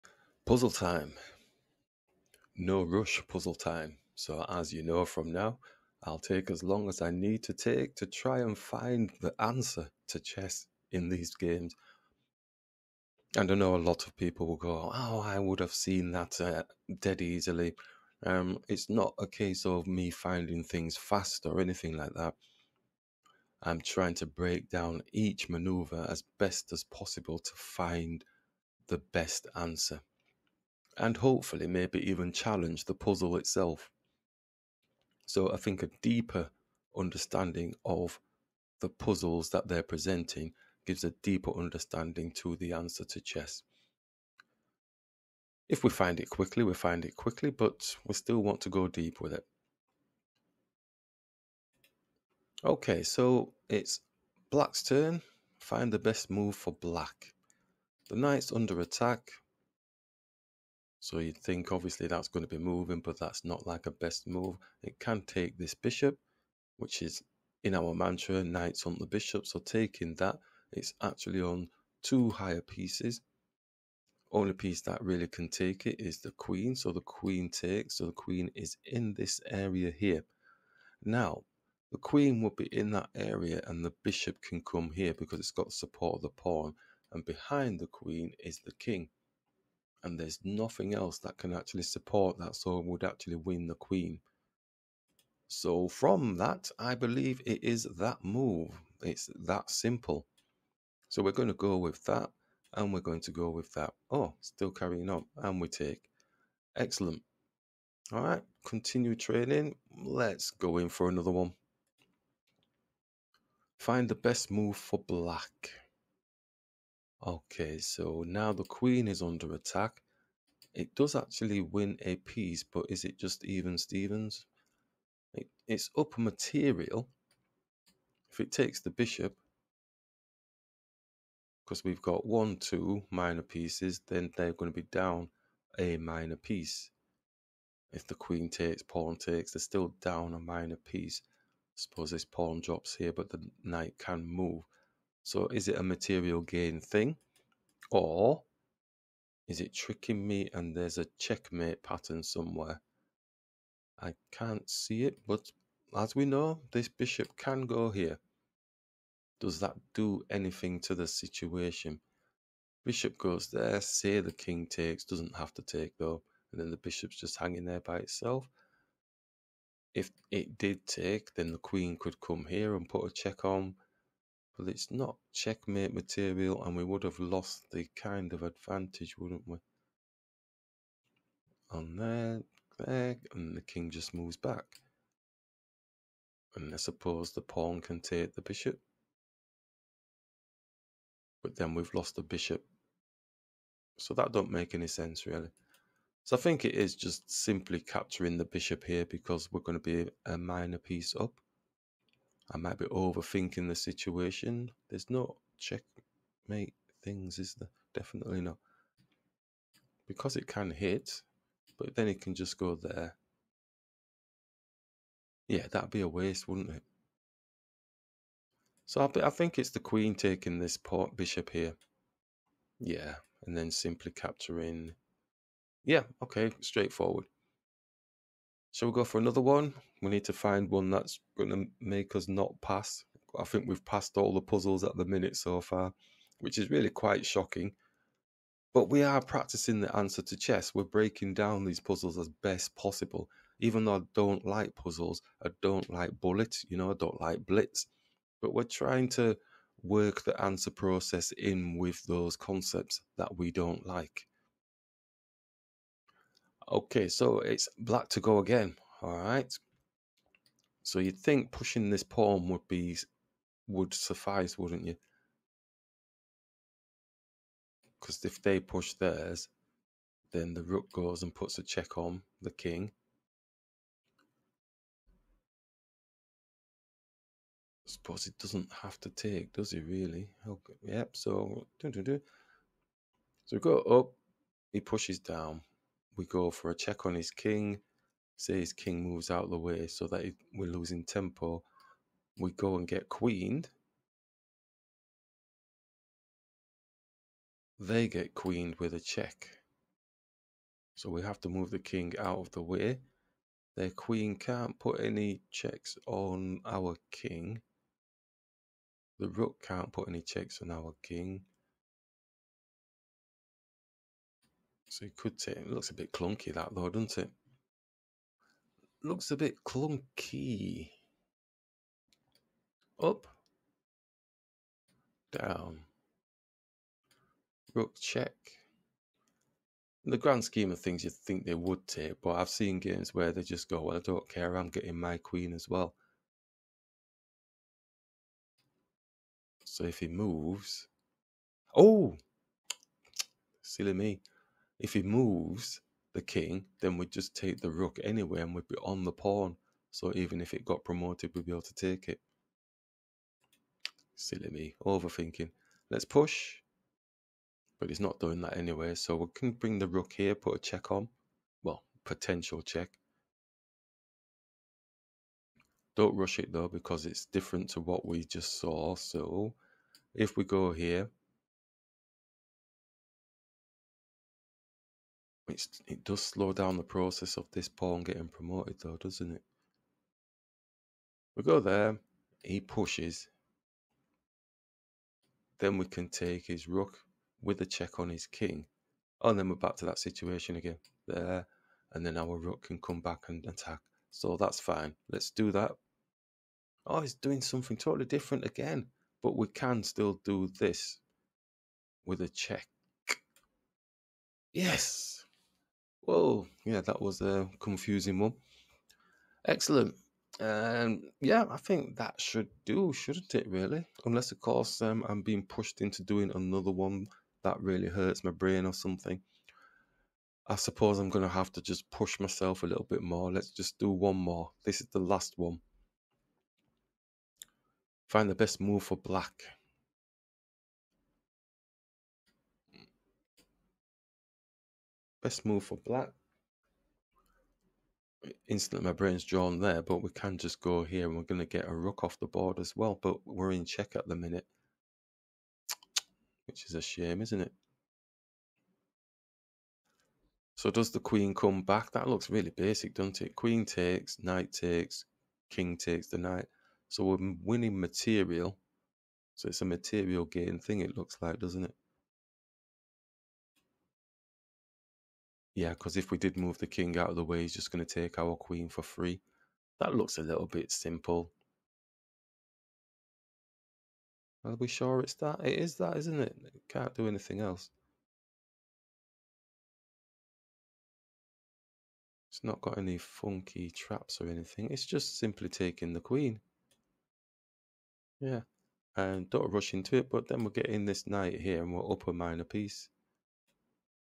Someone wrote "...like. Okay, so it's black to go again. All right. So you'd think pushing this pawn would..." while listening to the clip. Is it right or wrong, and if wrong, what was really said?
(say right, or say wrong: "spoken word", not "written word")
right.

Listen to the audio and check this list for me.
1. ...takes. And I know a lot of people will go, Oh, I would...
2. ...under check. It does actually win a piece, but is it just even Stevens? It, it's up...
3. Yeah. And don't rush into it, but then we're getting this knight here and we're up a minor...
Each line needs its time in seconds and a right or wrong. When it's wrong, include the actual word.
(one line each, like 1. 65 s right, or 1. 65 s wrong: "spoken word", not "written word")
1. 11 s wrong: "games", not "takes"
2. 119 s wrong: "attack", not "check"
3. 488 s right.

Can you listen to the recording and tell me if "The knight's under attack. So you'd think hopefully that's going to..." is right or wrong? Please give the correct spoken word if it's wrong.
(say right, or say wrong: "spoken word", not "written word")
wrong: "obviously", not "hopefully".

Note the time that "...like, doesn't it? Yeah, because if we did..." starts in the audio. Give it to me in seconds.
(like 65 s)
461 s.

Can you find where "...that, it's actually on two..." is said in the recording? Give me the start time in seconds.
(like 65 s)
70 s.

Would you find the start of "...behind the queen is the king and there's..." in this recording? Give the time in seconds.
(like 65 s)
87 s.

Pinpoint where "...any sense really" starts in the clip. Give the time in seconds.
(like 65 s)
194 s.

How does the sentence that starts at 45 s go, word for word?
If we find it quickly, we find it quickly, but we still want to go deep with it.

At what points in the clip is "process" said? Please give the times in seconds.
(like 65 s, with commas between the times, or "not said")
250 s, 376 s.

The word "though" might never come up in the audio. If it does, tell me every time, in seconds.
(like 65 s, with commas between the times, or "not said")
165 s, 243 s, 316 s, 366 s, 378 s.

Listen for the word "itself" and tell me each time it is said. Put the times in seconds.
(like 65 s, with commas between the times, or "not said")
33 s, 167 s.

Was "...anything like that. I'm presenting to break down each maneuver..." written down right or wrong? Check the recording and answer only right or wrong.
wrong.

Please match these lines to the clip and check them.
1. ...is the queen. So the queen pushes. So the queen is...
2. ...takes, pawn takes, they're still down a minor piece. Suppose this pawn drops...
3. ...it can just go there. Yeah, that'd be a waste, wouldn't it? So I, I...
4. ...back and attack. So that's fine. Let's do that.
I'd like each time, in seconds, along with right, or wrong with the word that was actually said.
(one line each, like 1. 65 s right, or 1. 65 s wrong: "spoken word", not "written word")
1. 75 s wrong: "takes", not "pushes"
2. 138 s right
3. 212 s right
4. 393 s right.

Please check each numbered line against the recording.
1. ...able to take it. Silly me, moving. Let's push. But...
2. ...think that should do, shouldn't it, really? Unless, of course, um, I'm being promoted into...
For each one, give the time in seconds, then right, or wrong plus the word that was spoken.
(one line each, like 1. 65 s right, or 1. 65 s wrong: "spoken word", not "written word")
1. 351 s wrong: "overthinking", not "moving"
2. 411 s wrong: "pushed", not "promoted".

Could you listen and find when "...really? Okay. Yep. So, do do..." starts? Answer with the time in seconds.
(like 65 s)
279 s.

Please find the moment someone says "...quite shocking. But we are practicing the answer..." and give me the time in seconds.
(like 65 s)
236 s.